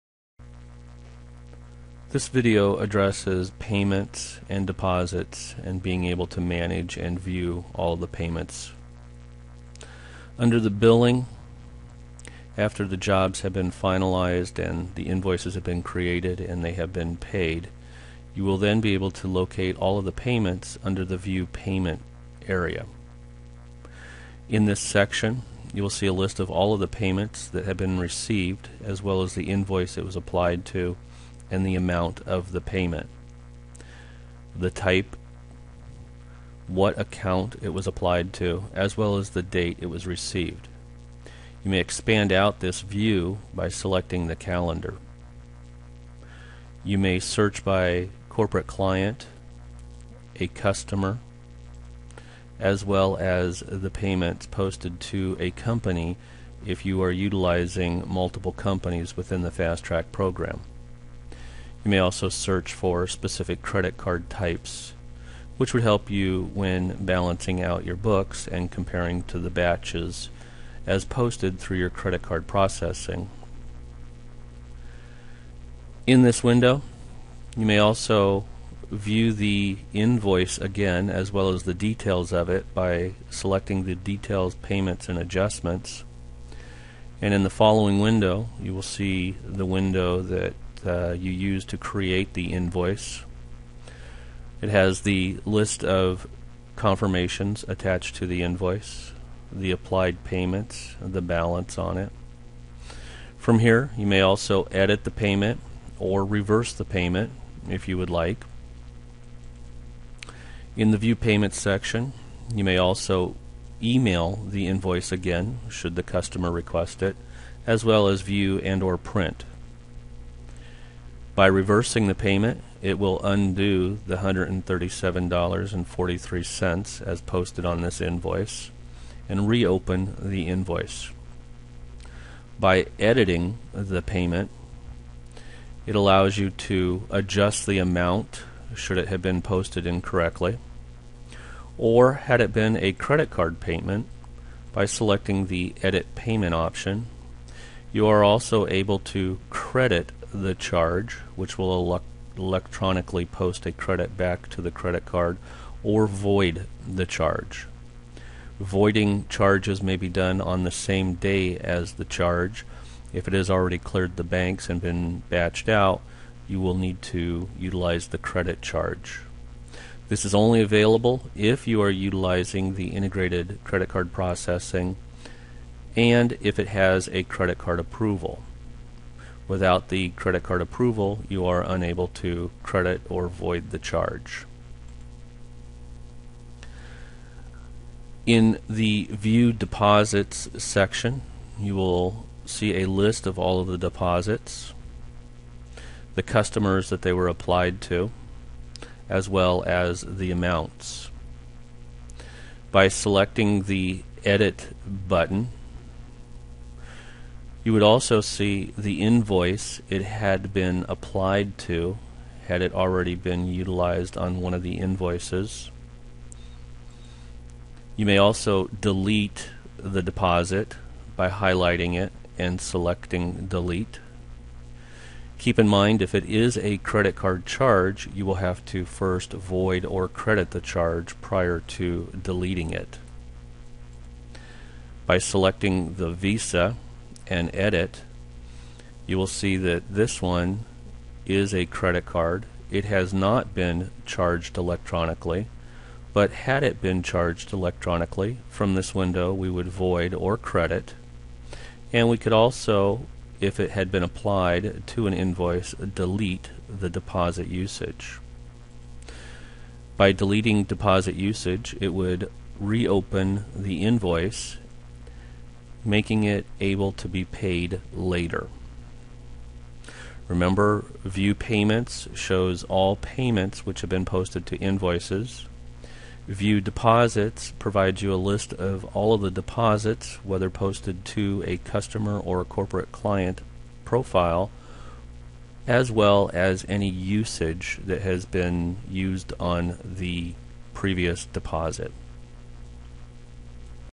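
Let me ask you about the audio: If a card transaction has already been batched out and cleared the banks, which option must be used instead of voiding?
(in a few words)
credit charge.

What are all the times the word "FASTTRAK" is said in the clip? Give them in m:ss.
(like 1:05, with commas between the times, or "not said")
0:59.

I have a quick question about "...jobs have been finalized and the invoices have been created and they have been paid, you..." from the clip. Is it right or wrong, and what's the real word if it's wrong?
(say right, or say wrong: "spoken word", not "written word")
right.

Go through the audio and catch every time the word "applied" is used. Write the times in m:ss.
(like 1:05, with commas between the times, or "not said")
0:30, 0:37, 1:39, 3:17, 3:30, 4:14.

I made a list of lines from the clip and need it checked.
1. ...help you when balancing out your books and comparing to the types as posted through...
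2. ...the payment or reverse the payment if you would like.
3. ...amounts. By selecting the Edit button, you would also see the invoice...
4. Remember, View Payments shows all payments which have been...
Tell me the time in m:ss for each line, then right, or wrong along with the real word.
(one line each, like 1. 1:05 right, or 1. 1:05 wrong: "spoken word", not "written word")
1. 1:05 wrong: "batches", not "types"
2. 1:45 right
3. 3:20 right
4. 4:30 right.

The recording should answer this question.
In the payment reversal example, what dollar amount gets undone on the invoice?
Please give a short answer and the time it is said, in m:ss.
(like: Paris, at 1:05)
$137.43, at 2:04.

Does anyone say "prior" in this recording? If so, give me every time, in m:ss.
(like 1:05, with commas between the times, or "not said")
3:51.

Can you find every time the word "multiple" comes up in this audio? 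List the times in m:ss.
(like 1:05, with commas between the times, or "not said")
0:58.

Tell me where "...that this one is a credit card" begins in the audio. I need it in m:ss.
3:59.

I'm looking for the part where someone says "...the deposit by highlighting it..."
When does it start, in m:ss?
3:39.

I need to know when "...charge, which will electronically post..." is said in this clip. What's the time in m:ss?
2:30.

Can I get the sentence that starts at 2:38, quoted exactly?
Voiding charges may be done on the same day as the charge.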